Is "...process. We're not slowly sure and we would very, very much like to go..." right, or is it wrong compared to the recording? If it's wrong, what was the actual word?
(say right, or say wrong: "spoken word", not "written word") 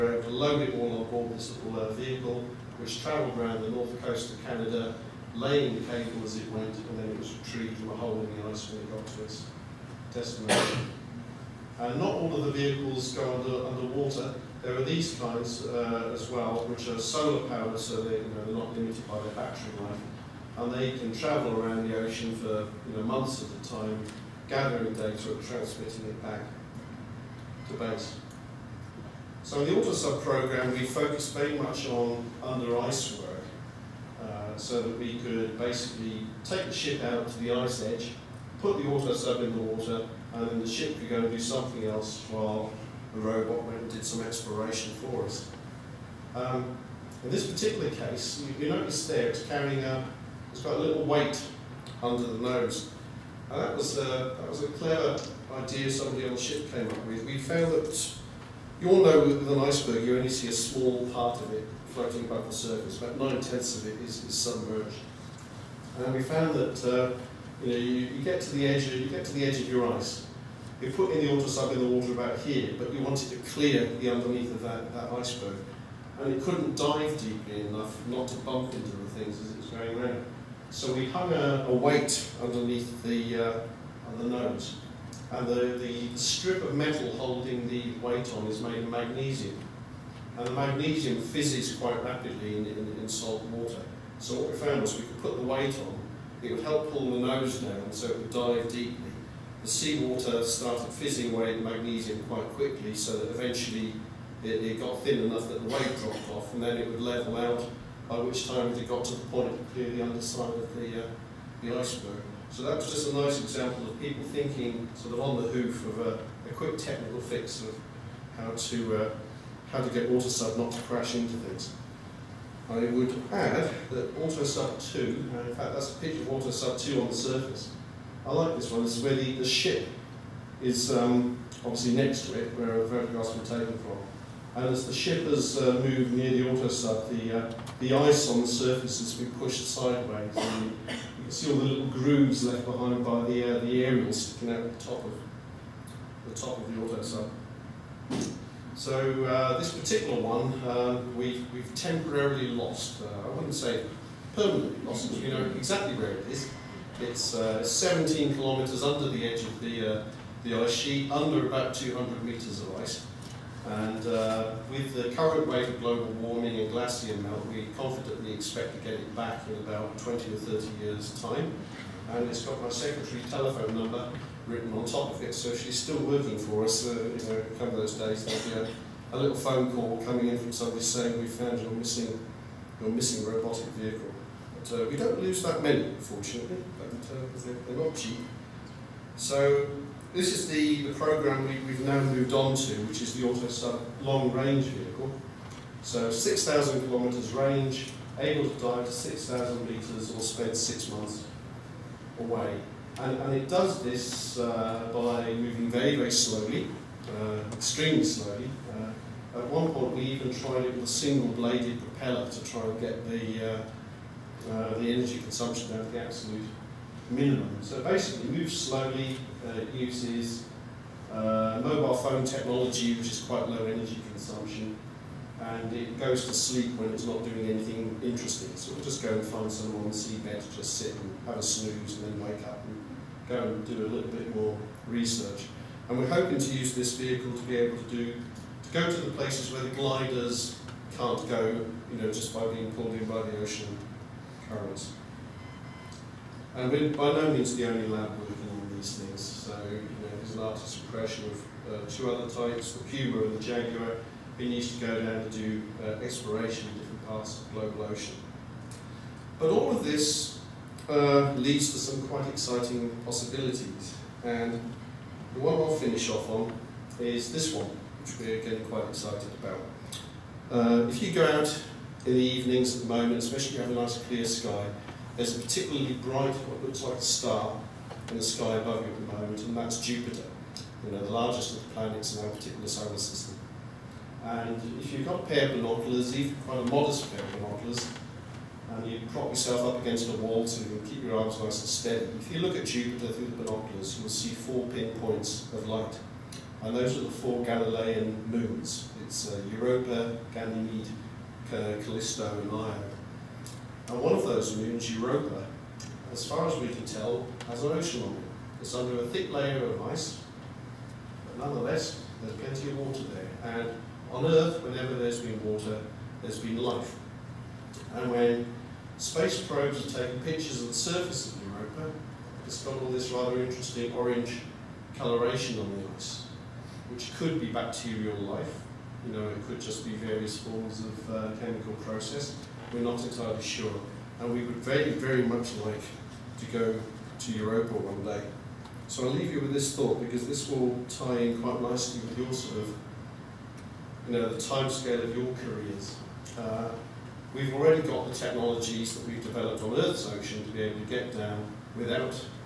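wrong: "entirely", not "slowly".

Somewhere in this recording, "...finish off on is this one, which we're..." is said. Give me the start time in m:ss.
4:25.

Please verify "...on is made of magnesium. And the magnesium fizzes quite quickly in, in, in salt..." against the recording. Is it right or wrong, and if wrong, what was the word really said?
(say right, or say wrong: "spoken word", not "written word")
wrong: "rapidly", not "quickly".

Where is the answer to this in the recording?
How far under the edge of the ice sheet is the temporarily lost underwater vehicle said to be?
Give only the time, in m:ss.
2:37.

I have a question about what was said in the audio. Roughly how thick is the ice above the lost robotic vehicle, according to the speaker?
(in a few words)
200 metres.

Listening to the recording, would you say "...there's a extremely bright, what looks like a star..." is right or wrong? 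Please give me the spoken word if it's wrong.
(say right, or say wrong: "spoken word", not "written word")
wrong: "particularly", not "extremely".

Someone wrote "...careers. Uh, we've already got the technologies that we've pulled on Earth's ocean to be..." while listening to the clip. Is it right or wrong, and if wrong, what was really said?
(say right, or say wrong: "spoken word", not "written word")
wrong: "developed", not "pulled".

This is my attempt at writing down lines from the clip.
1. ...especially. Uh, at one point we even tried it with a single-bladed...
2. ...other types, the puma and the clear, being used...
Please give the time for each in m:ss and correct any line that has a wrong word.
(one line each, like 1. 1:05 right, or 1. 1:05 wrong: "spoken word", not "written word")
1. 3:28 wrong: "slowly", not "especially"
2. 4:12 wrong: "jaguar", not "clear".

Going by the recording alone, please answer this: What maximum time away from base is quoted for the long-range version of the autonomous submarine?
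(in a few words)
six months.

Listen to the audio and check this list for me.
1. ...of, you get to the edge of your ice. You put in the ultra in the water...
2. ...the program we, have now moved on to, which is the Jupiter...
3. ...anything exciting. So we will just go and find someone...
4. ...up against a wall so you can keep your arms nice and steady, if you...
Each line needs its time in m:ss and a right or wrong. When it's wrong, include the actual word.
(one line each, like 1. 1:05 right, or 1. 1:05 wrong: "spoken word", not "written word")
1. 1:08 right
2. 3:10 wrong: "AutoSub", not "Jupiter"
3. 3:47 wrong: "interesting", not "exciting"
4. 4:49 right.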